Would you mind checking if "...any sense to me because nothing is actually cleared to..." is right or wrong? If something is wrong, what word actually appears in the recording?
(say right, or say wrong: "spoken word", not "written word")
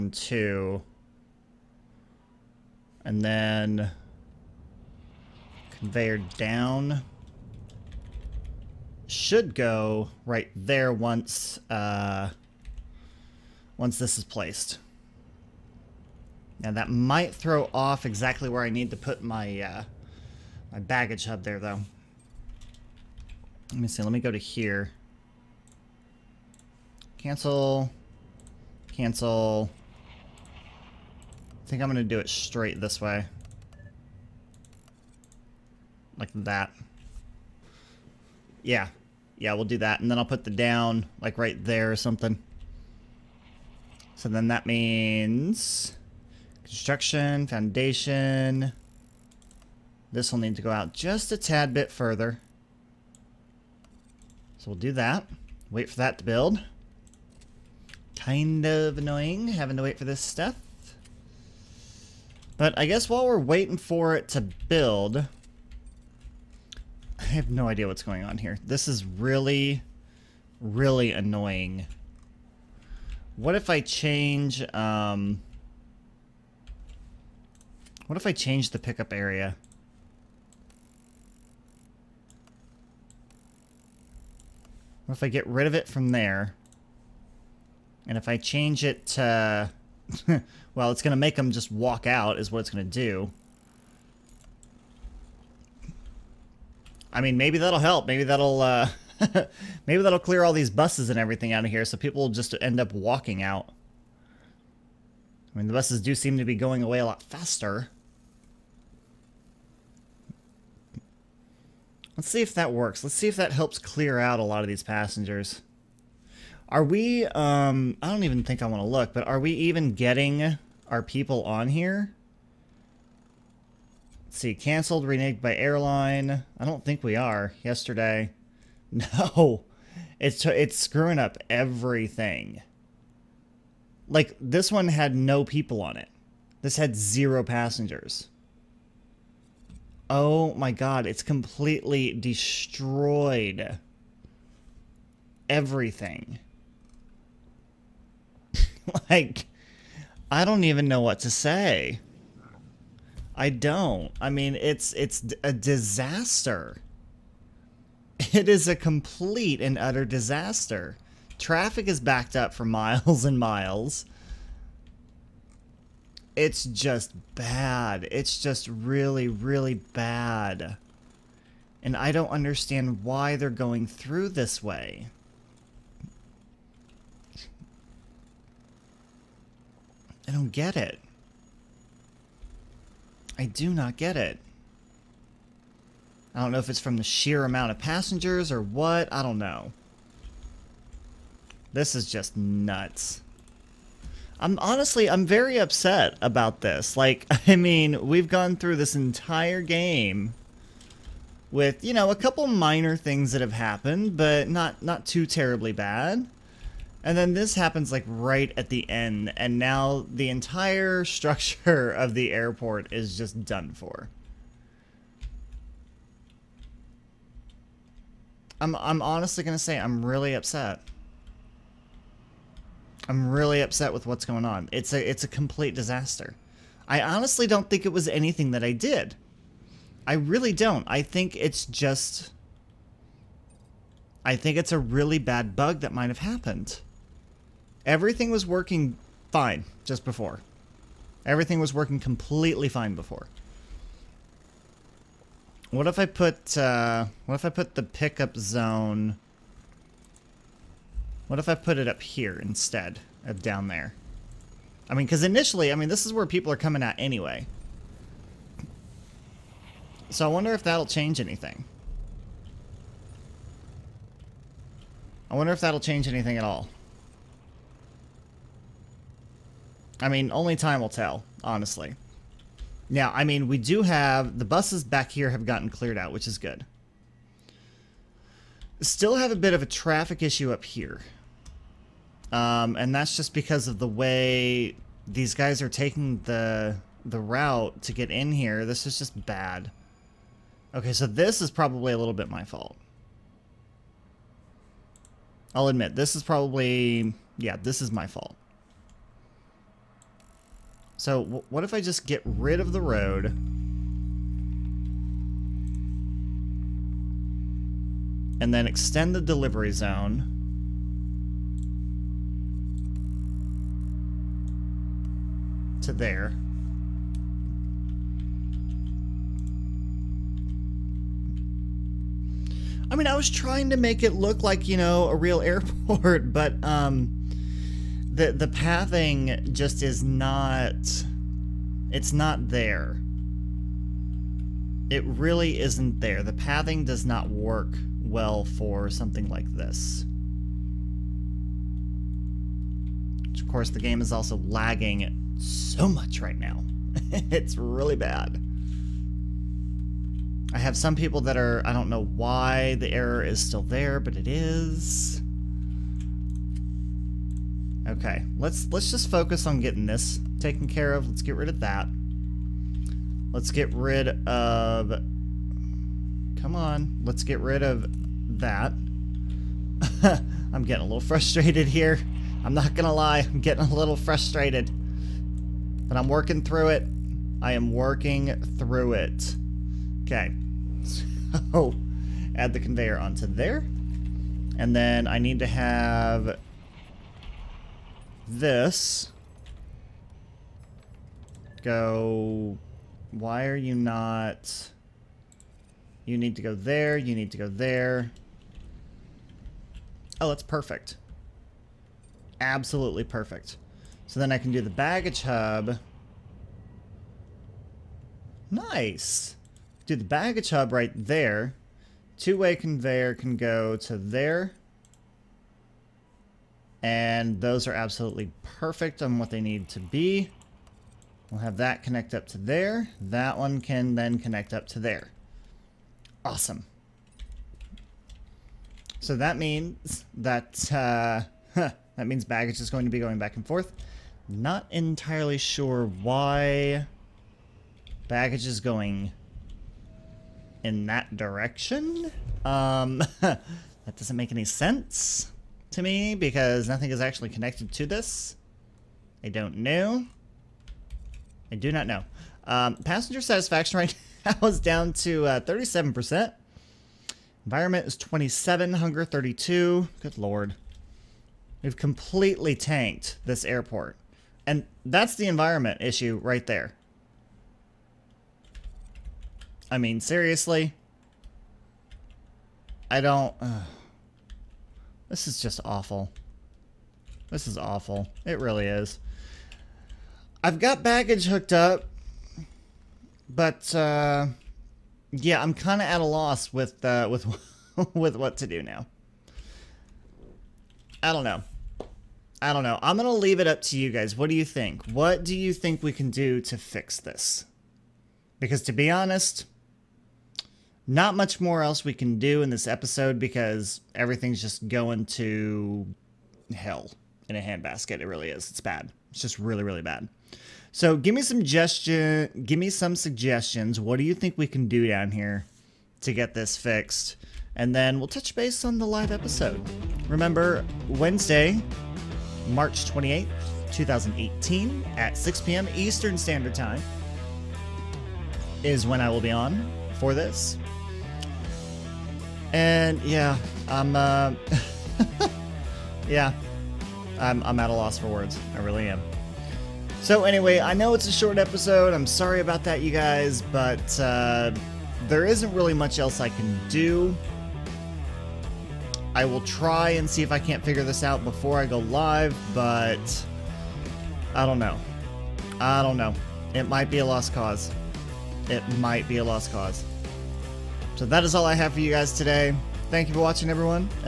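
wrong: "connected", not "cleared".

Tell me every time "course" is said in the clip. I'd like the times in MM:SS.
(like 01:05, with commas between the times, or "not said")
05:43.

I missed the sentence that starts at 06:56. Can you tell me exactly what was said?
And those are absolutely perfect on what they need to be.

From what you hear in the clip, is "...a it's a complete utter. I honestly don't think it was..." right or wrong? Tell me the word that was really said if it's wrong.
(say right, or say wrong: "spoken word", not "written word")
wrong: "disaster", not "utter".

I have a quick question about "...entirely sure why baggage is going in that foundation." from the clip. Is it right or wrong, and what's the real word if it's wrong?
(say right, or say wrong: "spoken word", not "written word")
wrong: "direction", not "foundation".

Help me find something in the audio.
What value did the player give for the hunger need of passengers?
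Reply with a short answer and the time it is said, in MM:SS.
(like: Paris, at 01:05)
32, at 07:38.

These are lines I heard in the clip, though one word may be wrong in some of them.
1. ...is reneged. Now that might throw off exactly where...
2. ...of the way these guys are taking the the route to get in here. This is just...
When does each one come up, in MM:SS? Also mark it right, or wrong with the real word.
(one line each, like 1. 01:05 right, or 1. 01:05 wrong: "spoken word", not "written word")
1. 00:14 wrong: "placed", not "reneged"
2. 04:43 right.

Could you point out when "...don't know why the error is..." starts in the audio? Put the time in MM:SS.
05:51.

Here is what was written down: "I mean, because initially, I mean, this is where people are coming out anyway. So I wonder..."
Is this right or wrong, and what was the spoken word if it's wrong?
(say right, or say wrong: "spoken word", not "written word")
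right.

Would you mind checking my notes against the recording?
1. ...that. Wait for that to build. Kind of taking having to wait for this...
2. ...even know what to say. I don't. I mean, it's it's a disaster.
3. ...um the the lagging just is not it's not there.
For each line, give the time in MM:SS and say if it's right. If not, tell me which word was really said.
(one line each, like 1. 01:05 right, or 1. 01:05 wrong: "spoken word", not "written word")
1. 00:54 wrong: "annoying", not "taking"
2. 02:30 right
3. 05:26 wrong: "pathing", not "lagging".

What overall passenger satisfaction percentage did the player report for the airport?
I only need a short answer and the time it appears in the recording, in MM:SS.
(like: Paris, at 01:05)
37%, at 07:35.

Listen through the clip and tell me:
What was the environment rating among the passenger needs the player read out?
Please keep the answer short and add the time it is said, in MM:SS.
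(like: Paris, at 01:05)
27, at 07:37.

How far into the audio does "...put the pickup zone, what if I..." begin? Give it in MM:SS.
04:07.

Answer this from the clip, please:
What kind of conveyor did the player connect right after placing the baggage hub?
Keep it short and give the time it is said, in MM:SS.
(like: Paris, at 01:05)
Two-way conveyor, at 06:52.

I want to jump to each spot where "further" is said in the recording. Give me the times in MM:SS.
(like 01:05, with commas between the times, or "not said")
00:51.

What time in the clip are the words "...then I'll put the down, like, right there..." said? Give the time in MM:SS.
00:40.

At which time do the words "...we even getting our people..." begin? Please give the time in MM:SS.
01:59.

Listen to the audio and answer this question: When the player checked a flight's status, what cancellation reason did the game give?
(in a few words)
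Reneged by airline.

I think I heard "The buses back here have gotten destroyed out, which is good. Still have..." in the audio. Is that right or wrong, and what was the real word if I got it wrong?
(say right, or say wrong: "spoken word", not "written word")
wrong: "cleared", not "destroyed".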